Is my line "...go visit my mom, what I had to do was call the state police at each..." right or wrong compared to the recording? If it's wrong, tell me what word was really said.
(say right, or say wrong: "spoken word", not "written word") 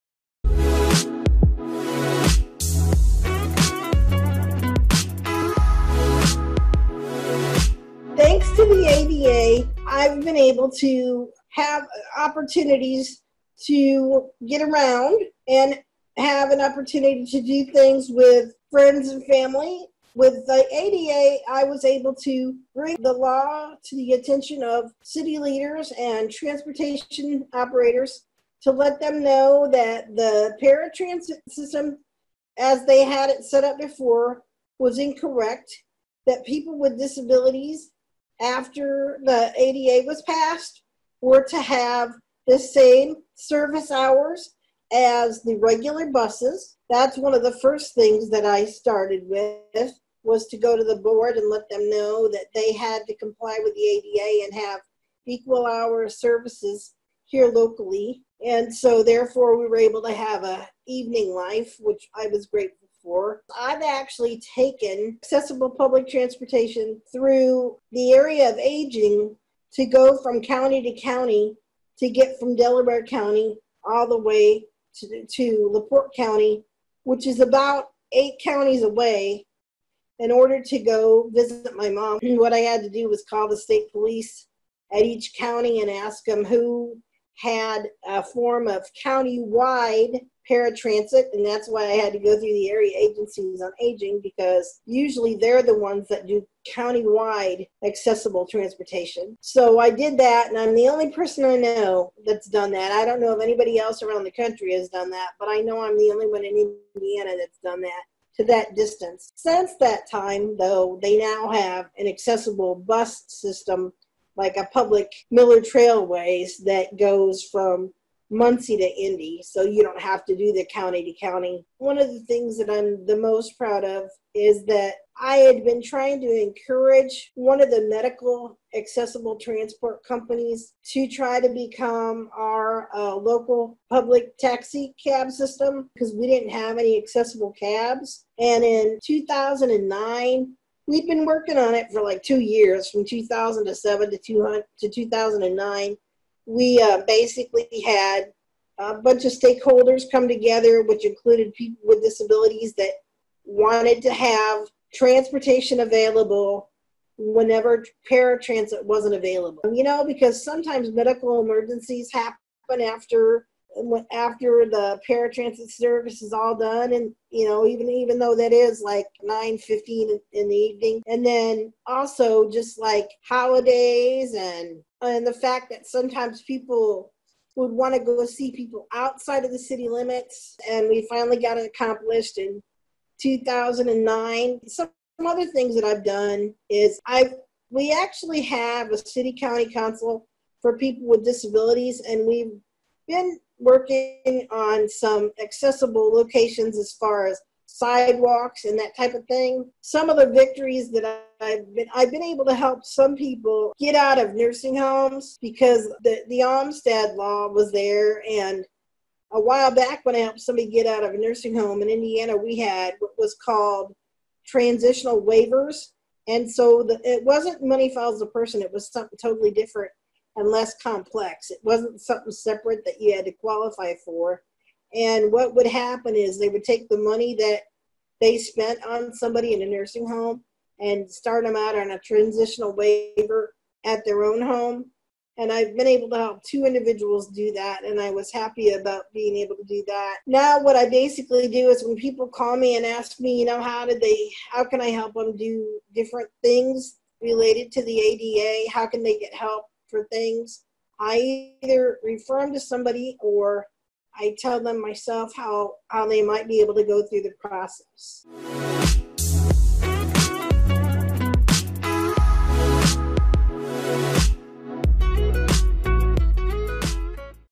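right.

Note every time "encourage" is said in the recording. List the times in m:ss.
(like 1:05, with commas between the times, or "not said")
2:06.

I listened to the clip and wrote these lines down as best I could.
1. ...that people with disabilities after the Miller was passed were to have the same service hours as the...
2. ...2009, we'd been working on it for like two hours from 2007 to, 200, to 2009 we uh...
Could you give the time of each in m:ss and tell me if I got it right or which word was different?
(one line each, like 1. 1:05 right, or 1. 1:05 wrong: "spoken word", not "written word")
1. 0:36 wrong: "ADA", not "Miller"
2. 2:19 wrong: "years", not "hours".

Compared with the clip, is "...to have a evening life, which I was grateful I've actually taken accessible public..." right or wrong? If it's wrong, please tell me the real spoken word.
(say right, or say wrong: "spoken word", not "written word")
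right.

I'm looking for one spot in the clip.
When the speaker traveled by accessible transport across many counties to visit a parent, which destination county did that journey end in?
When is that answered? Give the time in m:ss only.
1:15.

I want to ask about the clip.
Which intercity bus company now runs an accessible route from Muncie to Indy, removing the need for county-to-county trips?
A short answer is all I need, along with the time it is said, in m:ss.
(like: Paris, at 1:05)
Miller Trailways, at 1:55.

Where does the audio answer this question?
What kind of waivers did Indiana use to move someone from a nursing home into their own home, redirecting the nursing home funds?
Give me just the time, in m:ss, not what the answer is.
3:34.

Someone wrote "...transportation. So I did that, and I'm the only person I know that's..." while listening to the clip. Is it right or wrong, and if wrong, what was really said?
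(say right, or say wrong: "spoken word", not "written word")
right.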